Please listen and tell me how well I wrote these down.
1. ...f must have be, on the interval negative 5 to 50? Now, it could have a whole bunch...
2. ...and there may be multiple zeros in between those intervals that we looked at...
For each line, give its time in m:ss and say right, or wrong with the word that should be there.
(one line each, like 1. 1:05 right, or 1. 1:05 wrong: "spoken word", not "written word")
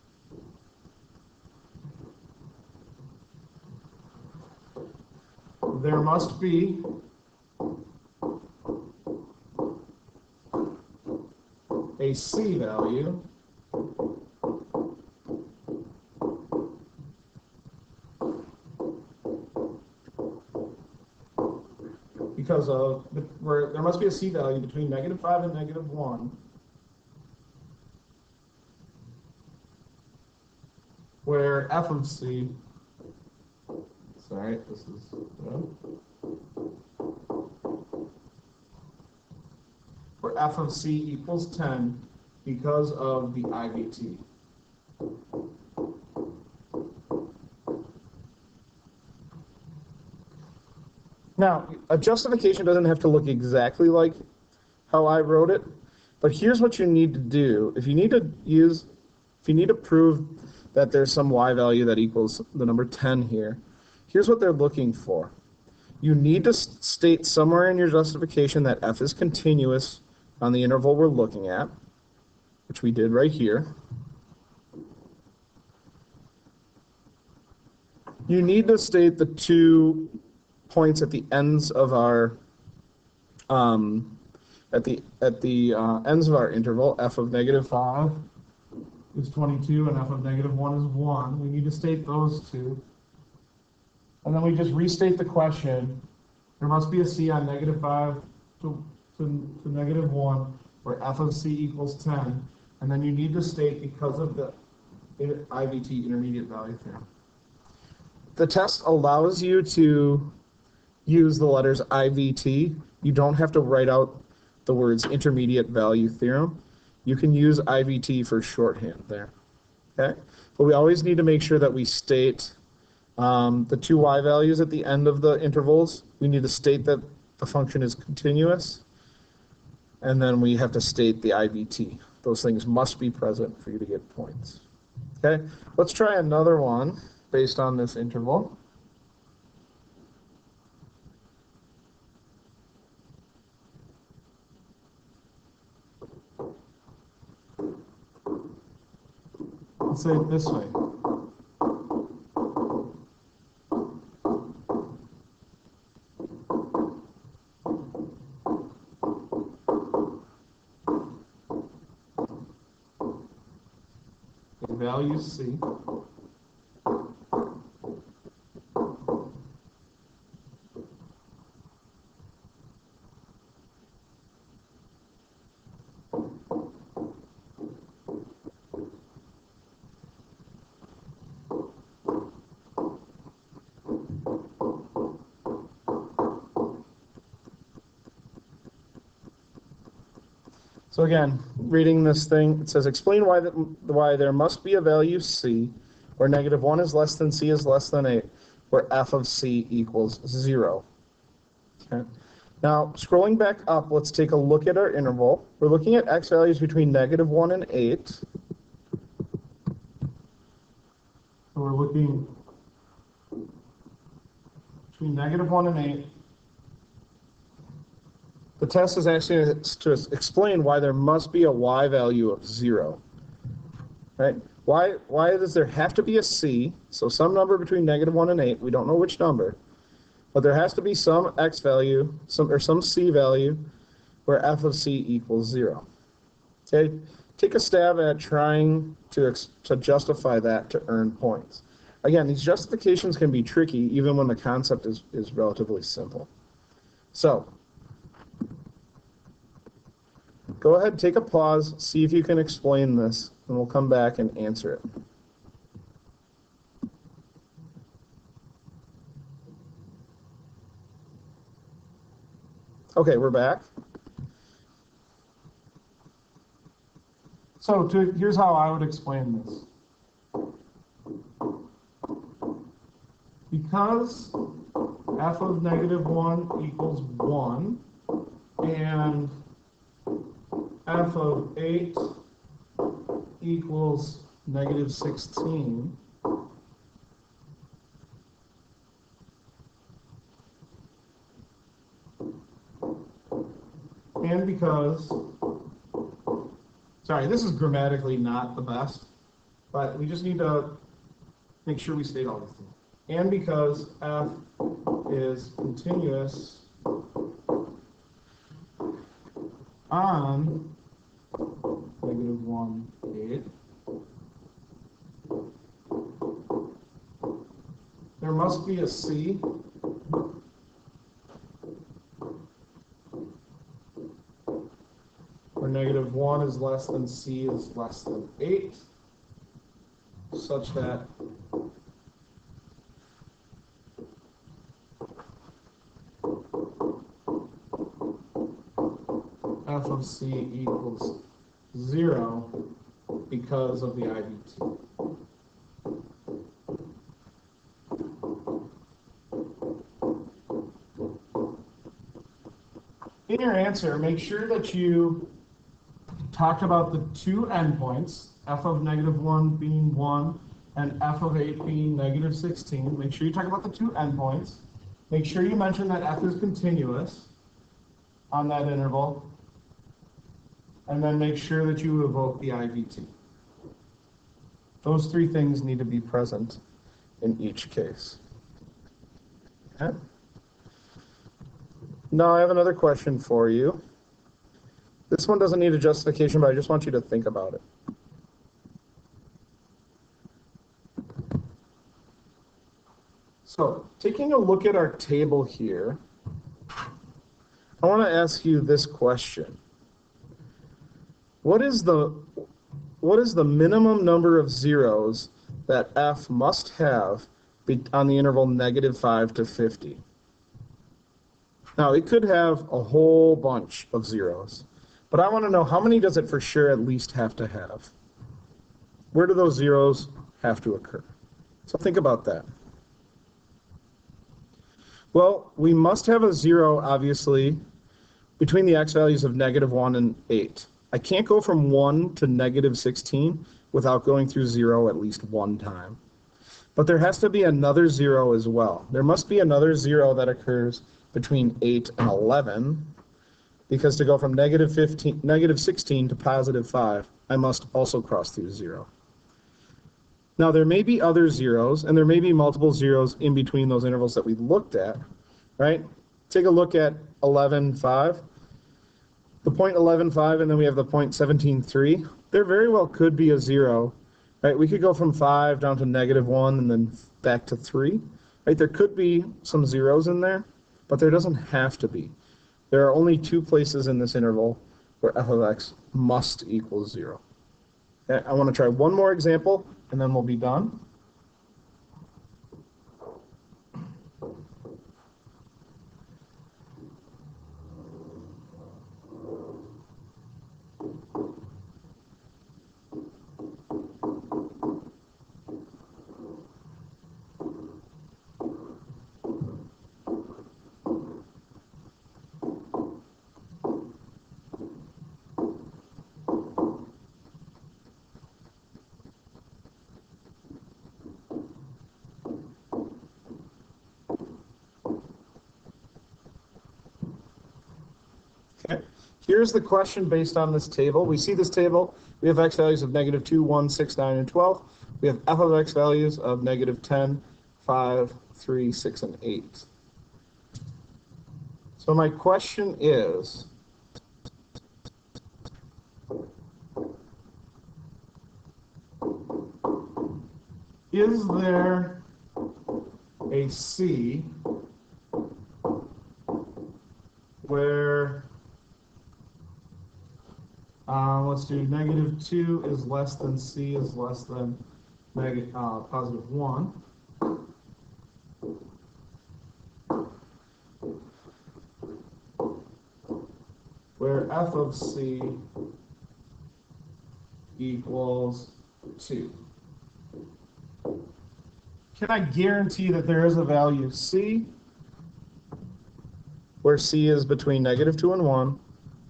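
1. 6:45 right
2. 7:31 right.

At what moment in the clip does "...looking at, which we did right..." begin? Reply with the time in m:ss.
1:11.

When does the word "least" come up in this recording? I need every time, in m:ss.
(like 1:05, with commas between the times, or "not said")
6:56, 7:14.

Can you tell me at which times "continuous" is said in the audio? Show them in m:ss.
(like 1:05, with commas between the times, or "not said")
1:09, 2:07, 5:05, 6:06.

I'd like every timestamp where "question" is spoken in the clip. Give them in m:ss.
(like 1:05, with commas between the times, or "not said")
1:35, 6:22, 6:38, 8:39, 8:52.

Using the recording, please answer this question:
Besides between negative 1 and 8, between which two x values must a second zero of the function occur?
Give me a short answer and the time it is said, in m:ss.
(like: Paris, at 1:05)
8 and 11, at 7:21.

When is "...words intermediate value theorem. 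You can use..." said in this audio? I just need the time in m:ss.
1:54.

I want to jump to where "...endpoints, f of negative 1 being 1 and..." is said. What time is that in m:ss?
5:57.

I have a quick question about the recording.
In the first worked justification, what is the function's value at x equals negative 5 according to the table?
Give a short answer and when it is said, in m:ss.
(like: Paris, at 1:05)
22, at 1:26.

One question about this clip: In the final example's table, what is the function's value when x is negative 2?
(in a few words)
-10.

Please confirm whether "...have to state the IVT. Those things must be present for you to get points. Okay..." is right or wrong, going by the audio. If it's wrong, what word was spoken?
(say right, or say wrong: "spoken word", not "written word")
right.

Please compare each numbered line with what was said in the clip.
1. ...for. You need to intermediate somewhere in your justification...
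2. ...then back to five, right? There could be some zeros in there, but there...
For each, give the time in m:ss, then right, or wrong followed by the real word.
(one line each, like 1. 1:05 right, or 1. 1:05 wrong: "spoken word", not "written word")
1. 1:04 wrong: "state", not "intermediate"
2. 7:46 wrong: "three", not "five".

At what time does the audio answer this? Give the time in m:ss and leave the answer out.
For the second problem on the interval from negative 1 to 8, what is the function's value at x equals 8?
4:40.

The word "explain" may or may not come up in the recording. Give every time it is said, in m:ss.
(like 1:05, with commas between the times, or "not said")
3:12, 3:40, 4:12, 4:28.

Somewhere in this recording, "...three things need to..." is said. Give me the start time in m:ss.
6:15.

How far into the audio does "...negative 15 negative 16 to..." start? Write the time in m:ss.
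7:24.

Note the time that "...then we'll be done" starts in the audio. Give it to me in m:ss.
8:00.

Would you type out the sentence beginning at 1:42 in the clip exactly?
And then you need to state because of the IVT intermediate value theorem.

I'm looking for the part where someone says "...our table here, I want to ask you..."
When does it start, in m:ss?
6:34.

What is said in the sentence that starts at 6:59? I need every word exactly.
Where do those zeros have to occur?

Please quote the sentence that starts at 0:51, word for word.
Now, a justification doesn't have to look exactly like how I wrote it, but here's what you need to do.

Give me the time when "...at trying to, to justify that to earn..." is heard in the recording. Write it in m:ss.
3:58.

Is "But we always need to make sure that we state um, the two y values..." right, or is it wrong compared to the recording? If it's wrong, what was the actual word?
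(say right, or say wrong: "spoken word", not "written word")
right.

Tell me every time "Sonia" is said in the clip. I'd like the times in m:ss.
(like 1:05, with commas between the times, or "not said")
not said.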